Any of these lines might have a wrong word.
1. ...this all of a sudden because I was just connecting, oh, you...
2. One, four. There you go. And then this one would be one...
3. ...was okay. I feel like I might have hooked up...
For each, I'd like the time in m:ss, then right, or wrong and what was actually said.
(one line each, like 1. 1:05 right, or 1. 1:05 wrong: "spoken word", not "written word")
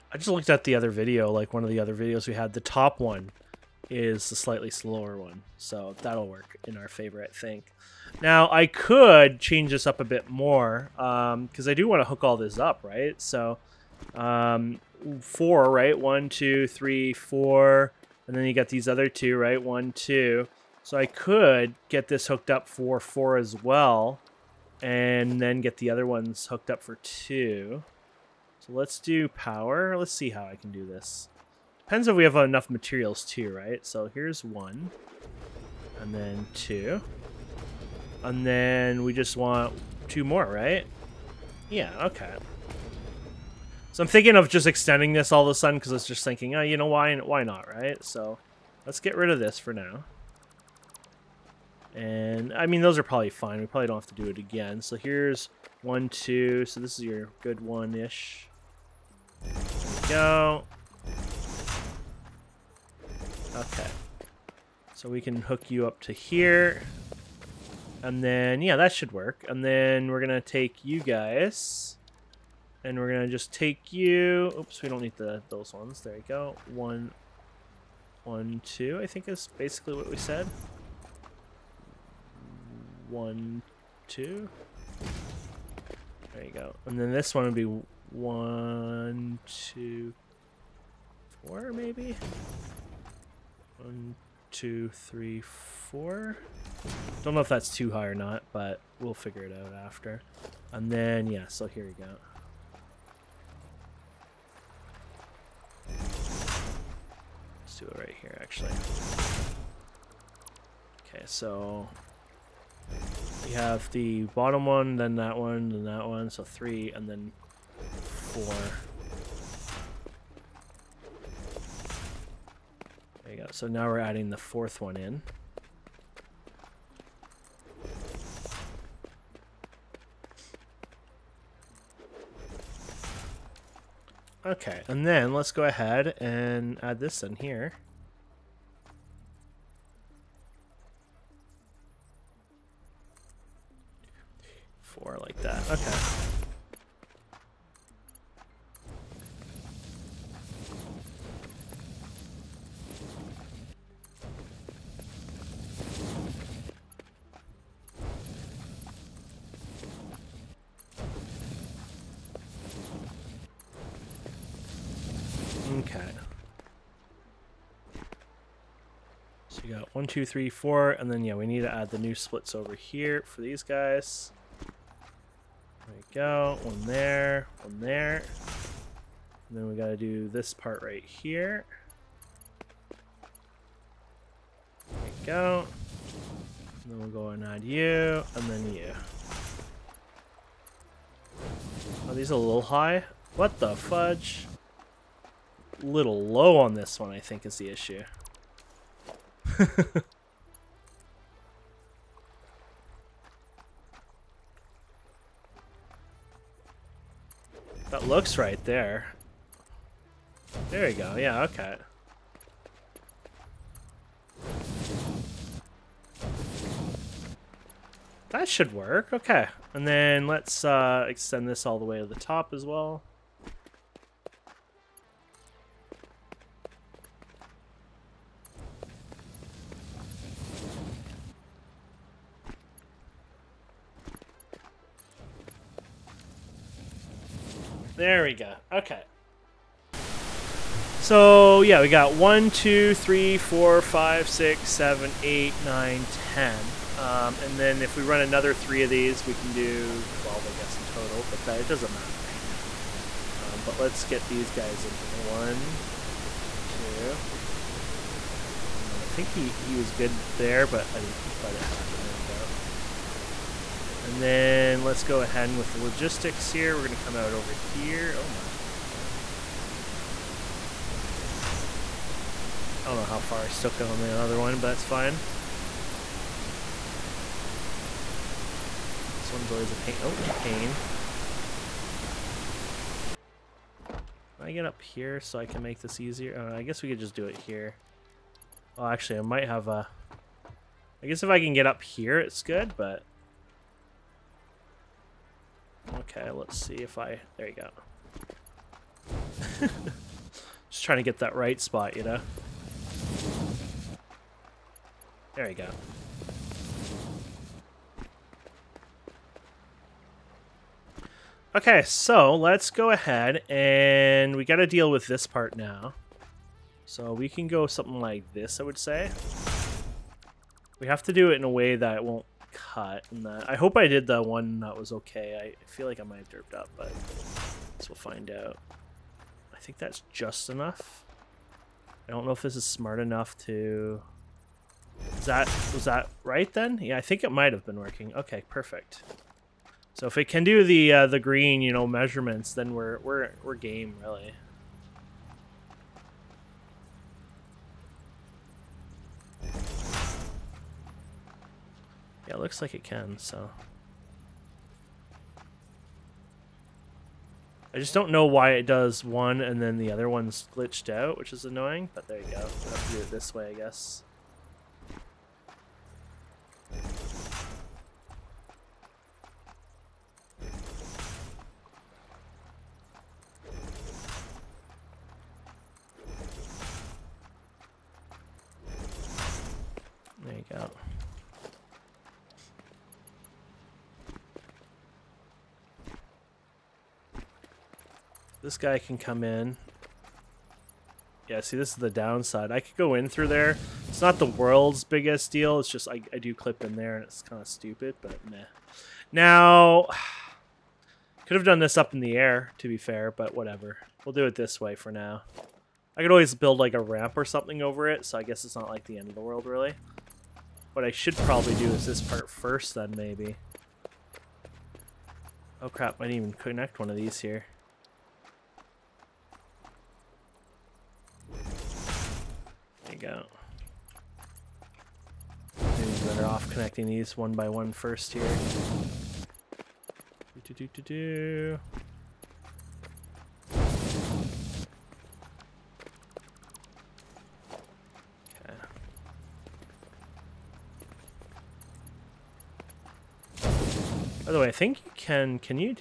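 1. 0:45 wrong: "thinking", not "connecting"
2. 1:23 wrong: "two", not "four"
3. 5:24 wrong: "derped", not "hooked".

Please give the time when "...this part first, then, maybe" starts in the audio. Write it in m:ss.
6:51.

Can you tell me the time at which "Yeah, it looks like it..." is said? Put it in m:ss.
5:52.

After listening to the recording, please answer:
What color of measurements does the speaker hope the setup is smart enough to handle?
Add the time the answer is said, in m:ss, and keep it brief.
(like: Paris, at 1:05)
Green, at 5:41.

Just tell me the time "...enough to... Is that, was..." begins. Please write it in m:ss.
5:32.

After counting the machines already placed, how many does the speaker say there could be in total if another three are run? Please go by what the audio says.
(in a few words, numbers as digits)
12.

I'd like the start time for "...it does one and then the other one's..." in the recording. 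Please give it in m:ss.
5:58.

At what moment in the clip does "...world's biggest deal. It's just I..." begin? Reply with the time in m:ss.
6:34.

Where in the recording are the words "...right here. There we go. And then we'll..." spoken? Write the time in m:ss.
3:00.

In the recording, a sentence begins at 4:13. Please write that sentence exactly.
Um, but let's get these guys in here.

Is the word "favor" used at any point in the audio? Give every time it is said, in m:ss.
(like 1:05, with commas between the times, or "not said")
0:06.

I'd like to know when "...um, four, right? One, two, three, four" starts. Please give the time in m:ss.
0:14.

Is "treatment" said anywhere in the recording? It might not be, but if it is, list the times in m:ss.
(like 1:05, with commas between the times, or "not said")
not said.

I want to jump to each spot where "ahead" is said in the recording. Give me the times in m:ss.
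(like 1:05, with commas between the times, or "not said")
2:15, 4:25, 5:12.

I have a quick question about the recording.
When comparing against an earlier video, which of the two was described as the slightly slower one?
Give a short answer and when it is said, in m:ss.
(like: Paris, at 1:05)
The top one, at 0:02.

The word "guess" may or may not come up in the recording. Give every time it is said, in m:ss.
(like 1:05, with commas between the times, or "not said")
4:10, 4:46, 4:51, 6:03, 6:48.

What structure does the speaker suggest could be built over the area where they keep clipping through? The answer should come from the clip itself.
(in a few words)
A ramp.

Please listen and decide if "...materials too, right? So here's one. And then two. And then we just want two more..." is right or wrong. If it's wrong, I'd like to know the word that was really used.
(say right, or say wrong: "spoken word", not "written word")
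right.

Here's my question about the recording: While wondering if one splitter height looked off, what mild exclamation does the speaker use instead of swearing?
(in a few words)
What the fudge.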